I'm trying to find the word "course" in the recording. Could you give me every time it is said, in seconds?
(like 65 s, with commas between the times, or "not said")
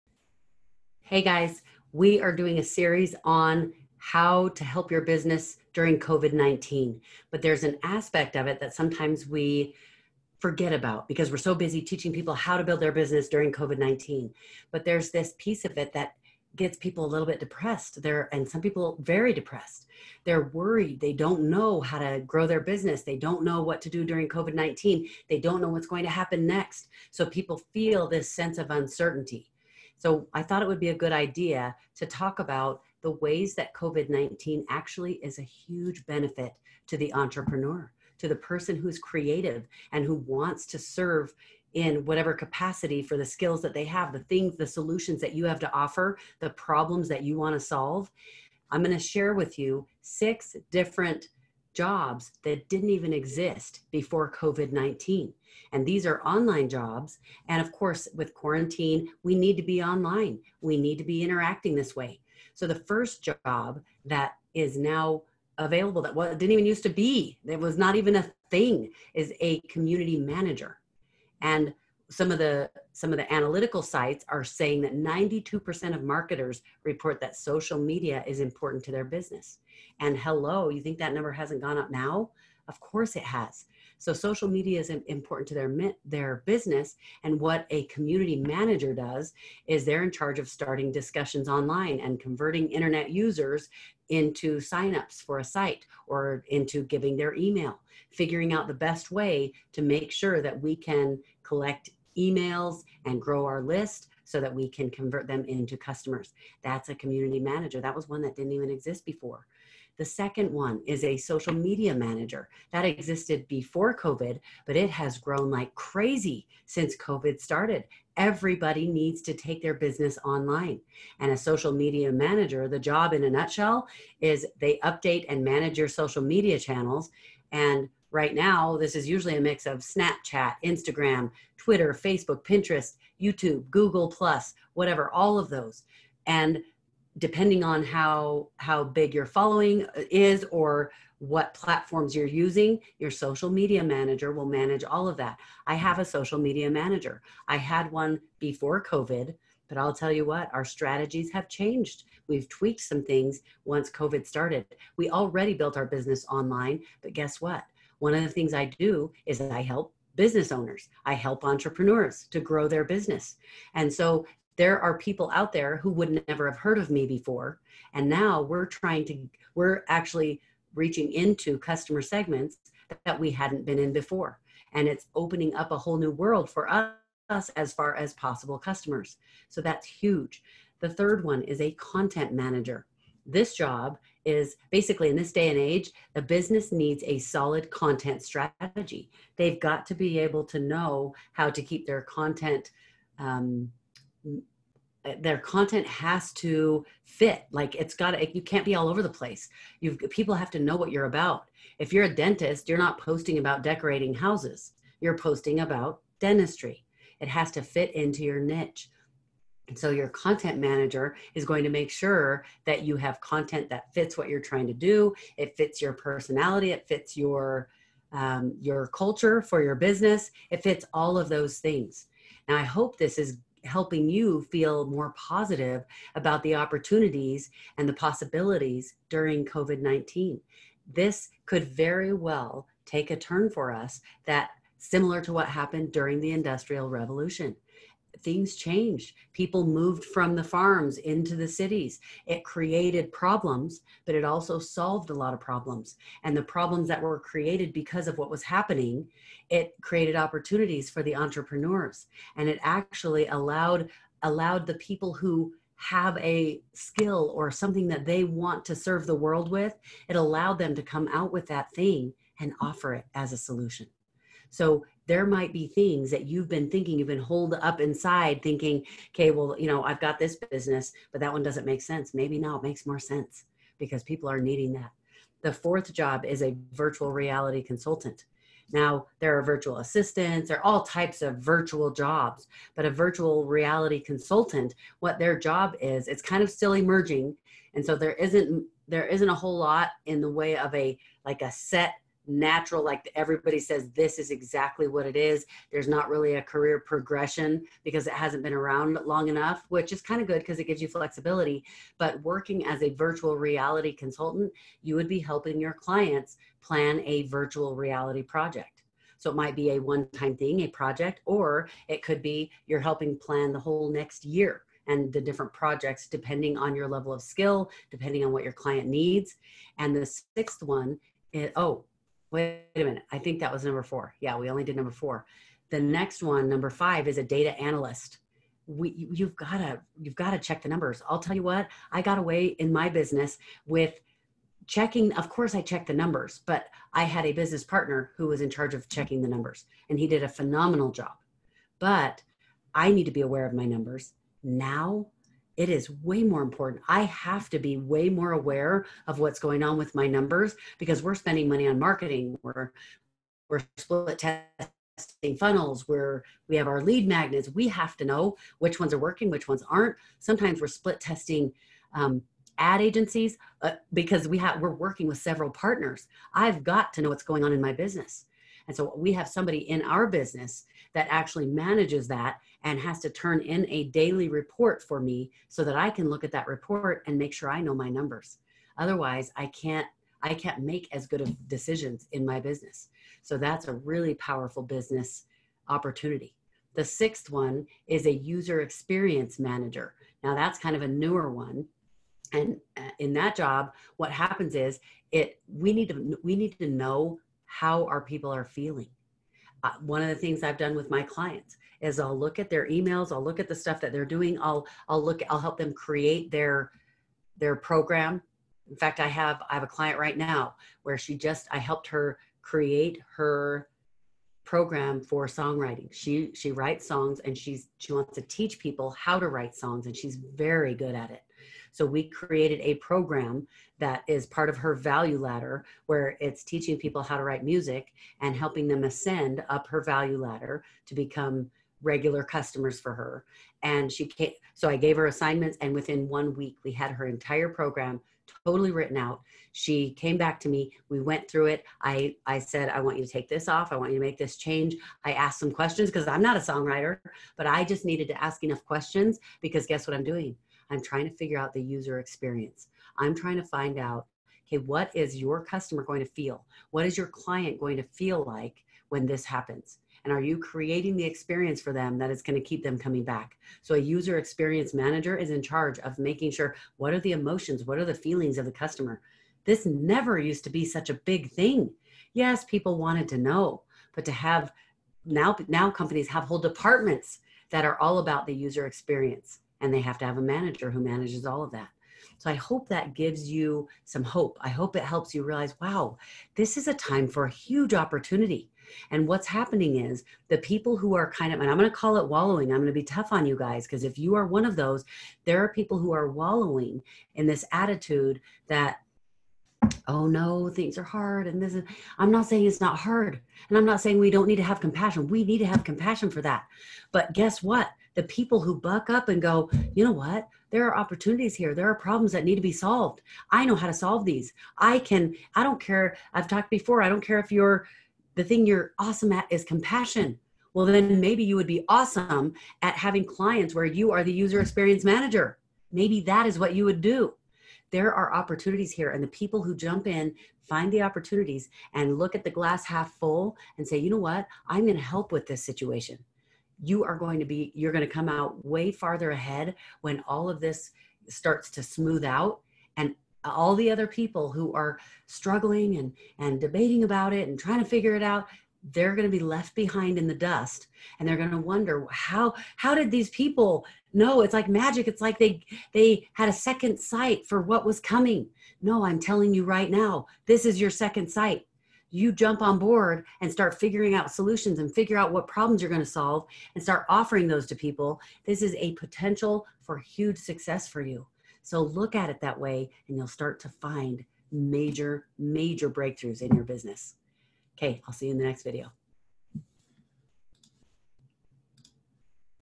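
57 s, 82 s, 335 s.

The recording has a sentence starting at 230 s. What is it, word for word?
This could very well take a turn for us that similar to what happened during the Industrial Revolution things changed.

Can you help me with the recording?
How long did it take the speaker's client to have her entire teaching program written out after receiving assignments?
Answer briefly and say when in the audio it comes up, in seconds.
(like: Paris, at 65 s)
One week, at 436 s.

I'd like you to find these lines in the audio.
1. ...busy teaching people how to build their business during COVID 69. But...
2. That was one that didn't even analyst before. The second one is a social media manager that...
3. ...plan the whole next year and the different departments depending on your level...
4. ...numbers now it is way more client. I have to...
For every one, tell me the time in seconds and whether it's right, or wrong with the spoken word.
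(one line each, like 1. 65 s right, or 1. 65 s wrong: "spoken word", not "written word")
1. 11 s wrong: "19", not "69"
2. 107 s wrong: "exist", not "analyst"
3. 313 s wrong: "projects", not "departments"
4. 343 s wrong: "important", not "client".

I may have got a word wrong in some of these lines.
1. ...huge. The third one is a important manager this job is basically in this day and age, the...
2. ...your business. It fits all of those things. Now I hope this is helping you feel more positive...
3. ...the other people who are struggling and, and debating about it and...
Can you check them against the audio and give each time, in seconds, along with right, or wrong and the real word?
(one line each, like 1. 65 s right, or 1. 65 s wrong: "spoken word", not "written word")
1. 179 s wrong: "content", not "important"
2. 219 s right
3. 543 s right.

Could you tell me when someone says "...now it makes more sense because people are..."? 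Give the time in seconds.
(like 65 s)
272 s.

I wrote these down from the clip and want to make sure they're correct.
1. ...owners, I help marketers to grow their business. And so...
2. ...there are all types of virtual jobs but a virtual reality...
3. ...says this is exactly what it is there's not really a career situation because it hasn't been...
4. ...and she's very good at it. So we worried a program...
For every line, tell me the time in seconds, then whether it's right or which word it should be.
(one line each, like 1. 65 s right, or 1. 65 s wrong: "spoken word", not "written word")
1. 160 s wrong: "entrepreneurs", not "marketers"
2. 280 s right
3. 293 s wrong: "progression", not "situation"
4. 419 s wrong: "created", not "worried".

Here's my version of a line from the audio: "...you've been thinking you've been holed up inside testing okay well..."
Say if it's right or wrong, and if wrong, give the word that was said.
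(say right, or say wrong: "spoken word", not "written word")
wrong: "thinking", not "testing".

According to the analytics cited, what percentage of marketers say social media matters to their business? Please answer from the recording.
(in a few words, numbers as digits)
92%.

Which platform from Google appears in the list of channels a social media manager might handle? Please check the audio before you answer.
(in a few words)
Google Plus.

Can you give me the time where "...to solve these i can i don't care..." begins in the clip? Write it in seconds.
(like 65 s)
513 s.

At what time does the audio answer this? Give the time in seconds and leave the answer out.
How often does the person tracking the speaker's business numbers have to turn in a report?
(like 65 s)
373 s.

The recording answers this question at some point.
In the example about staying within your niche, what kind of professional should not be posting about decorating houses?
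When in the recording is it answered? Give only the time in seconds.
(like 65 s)
202 s.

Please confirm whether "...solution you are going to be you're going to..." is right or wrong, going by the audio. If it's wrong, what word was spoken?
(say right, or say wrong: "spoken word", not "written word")
wrong: "situation", not "solution".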